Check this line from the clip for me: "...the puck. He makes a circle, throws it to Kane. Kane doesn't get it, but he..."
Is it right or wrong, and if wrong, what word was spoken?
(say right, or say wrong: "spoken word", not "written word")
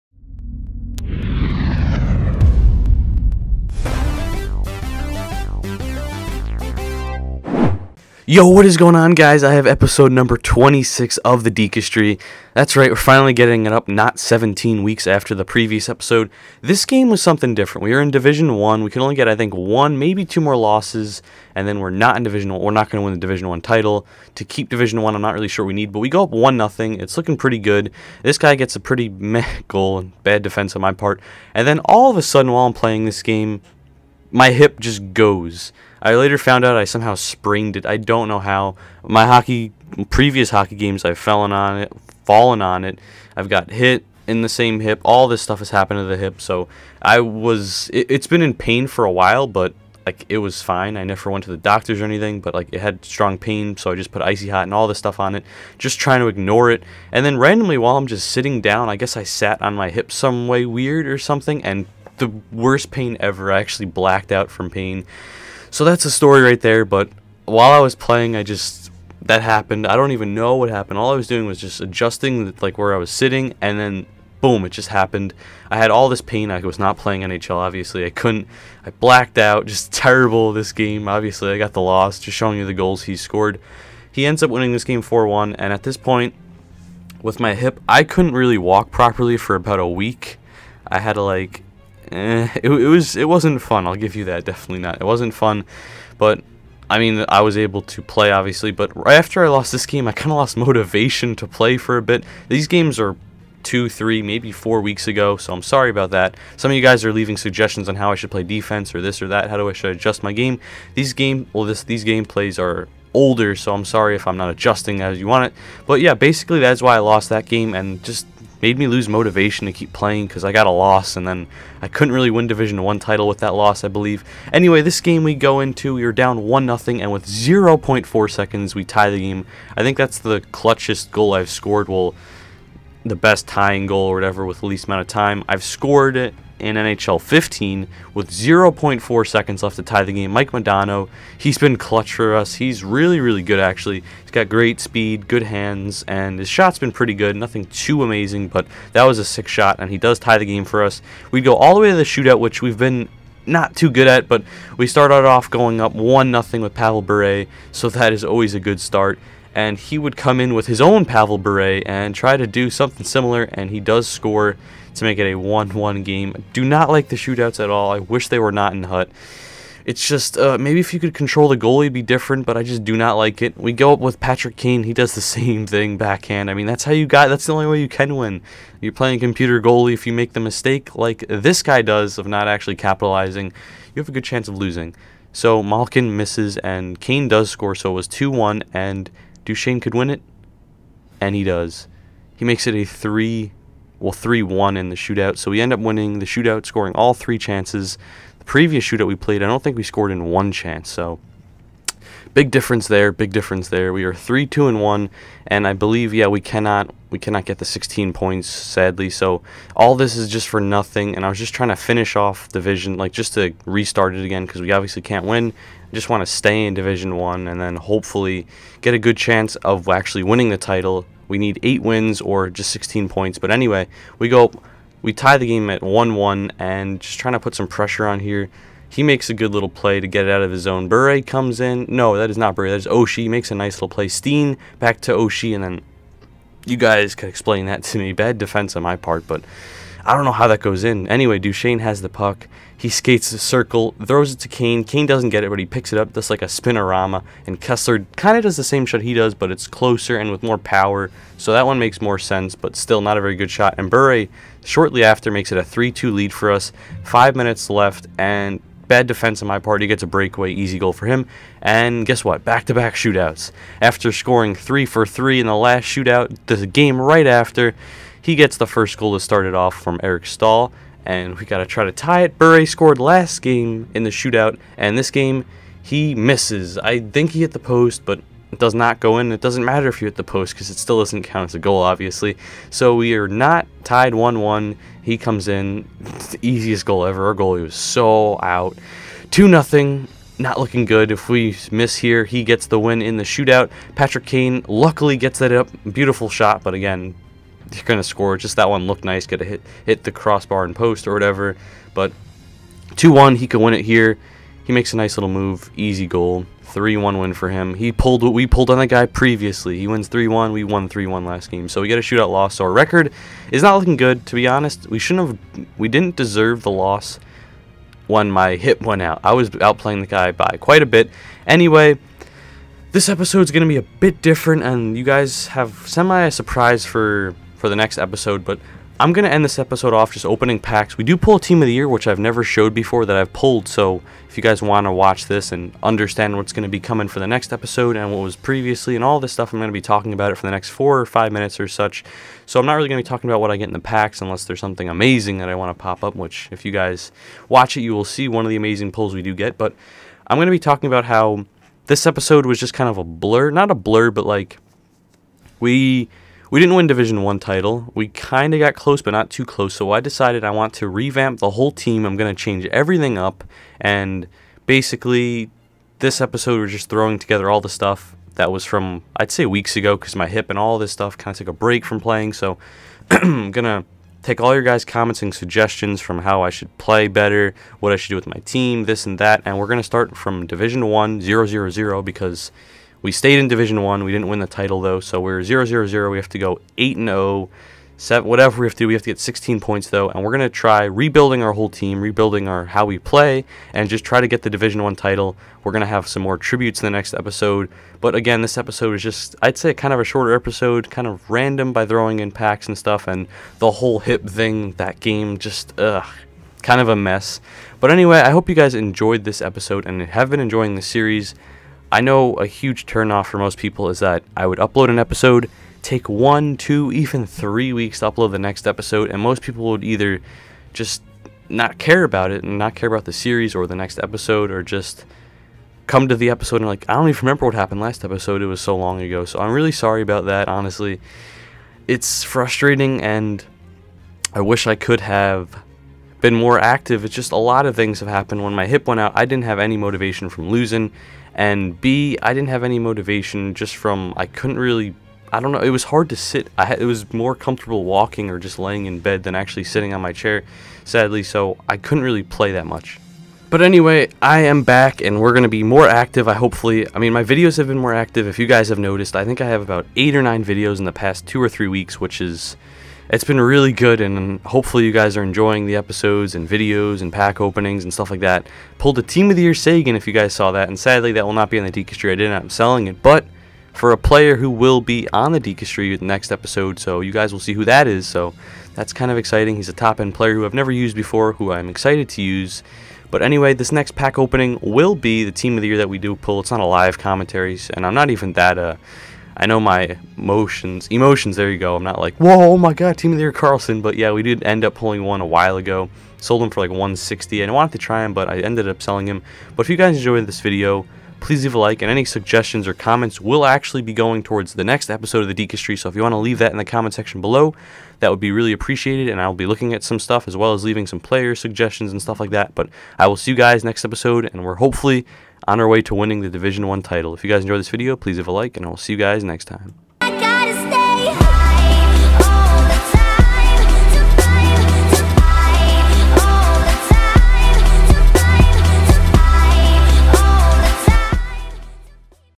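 wrong: "skates", not "makes".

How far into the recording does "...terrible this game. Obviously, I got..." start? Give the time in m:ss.
1:19.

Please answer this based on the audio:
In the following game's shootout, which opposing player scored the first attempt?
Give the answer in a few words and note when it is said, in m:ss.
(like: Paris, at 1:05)
Eric Staal, at 4:30.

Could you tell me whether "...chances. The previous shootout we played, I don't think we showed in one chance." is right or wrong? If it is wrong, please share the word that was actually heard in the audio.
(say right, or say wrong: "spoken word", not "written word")
wrong: "scored", not "showed".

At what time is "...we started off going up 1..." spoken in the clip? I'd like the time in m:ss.
2:34.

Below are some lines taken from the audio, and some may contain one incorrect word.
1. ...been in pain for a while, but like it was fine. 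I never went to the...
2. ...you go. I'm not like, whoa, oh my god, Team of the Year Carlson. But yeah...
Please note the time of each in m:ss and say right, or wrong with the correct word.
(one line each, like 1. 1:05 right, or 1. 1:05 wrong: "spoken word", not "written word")
1. 0:48 right
2. 8:11 right.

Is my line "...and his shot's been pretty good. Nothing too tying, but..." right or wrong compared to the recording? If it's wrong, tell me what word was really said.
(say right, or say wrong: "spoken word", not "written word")
wrong: "amazing", not "tying".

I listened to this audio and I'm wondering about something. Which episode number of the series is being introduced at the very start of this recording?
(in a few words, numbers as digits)
26.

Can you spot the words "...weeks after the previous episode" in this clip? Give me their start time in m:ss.
0:14.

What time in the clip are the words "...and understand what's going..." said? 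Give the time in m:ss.
5:35.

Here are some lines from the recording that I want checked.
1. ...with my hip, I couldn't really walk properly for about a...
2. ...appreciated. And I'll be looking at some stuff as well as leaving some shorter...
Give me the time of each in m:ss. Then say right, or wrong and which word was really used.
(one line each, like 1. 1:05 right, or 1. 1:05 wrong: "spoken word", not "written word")
1. 1:27 right
2. 8:28 wrong: "player", not "shorter".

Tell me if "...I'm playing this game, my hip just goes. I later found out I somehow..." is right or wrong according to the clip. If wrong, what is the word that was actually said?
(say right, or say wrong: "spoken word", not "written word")
right.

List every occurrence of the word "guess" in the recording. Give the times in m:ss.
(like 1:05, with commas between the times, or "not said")
0:58, 4:22.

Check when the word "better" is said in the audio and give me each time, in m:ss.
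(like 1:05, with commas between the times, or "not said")
6:17.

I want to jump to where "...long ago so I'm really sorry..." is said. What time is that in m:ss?
7:08.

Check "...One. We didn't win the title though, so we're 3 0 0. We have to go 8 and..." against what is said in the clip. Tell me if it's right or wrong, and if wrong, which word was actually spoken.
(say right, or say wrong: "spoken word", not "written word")
wrong: "0", not "3".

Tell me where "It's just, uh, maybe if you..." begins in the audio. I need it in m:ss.
2:49.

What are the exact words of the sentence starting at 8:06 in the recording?
It's not a live commentary, and I'm not even that.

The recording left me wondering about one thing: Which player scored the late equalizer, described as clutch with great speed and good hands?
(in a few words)
Mike Modano.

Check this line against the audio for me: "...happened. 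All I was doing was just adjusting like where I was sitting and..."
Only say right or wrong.
right.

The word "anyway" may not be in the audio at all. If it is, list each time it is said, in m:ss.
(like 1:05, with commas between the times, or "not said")
2:04, 3:43, 4:01, 5:21, 6:47, 7:33, 8:03.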